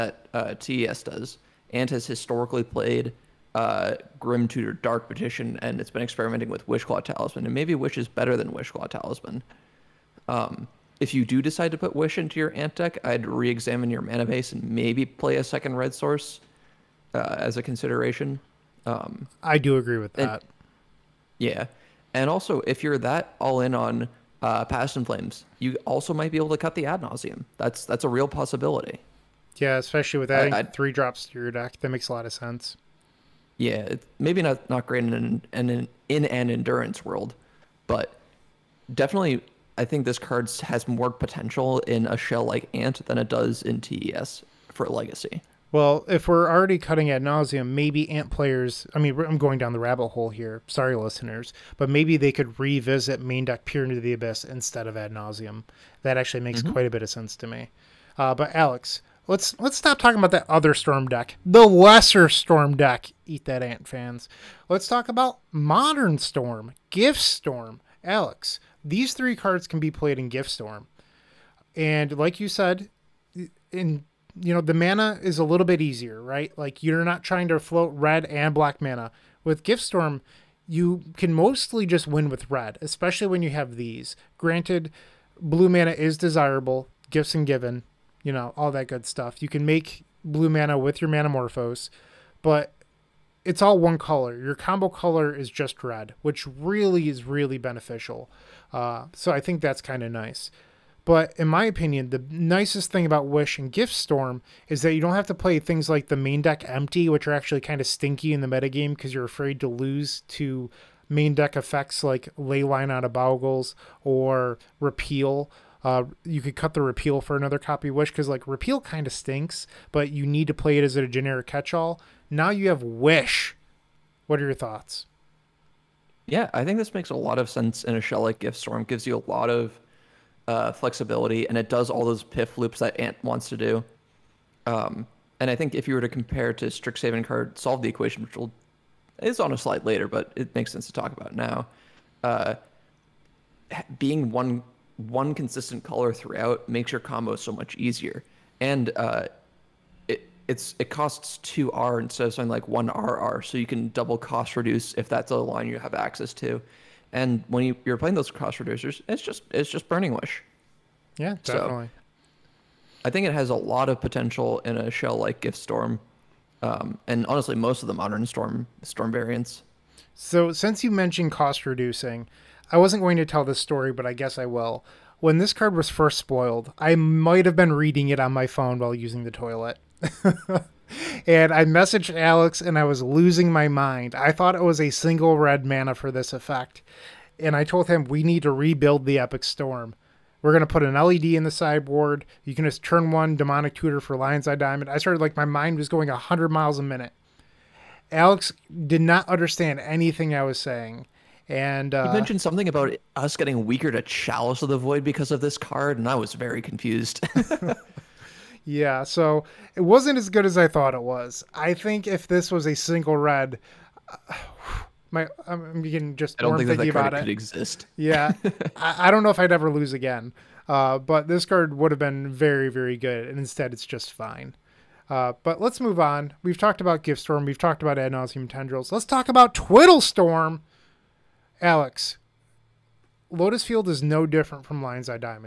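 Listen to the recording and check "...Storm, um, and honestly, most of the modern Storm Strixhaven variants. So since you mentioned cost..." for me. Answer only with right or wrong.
wrong.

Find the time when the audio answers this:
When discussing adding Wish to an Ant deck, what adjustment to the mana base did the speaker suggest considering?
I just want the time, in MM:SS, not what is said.
00:15.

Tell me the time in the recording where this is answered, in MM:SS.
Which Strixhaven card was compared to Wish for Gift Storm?
02:17.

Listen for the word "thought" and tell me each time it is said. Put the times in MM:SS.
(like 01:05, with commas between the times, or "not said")
02:04, 03:04, 03:30.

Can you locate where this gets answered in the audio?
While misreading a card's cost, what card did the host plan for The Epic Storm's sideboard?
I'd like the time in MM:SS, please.
03:10.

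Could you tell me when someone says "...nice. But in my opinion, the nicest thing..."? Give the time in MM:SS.
01:40.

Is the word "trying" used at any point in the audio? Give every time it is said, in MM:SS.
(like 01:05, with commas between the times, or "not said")
01:17.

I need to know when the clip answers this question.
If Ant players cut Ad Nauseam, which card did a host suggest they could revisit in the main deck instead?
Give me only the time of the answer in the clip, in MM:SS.
00:53.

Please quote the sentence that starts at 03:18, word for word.
Alex did not understand anything I was saying.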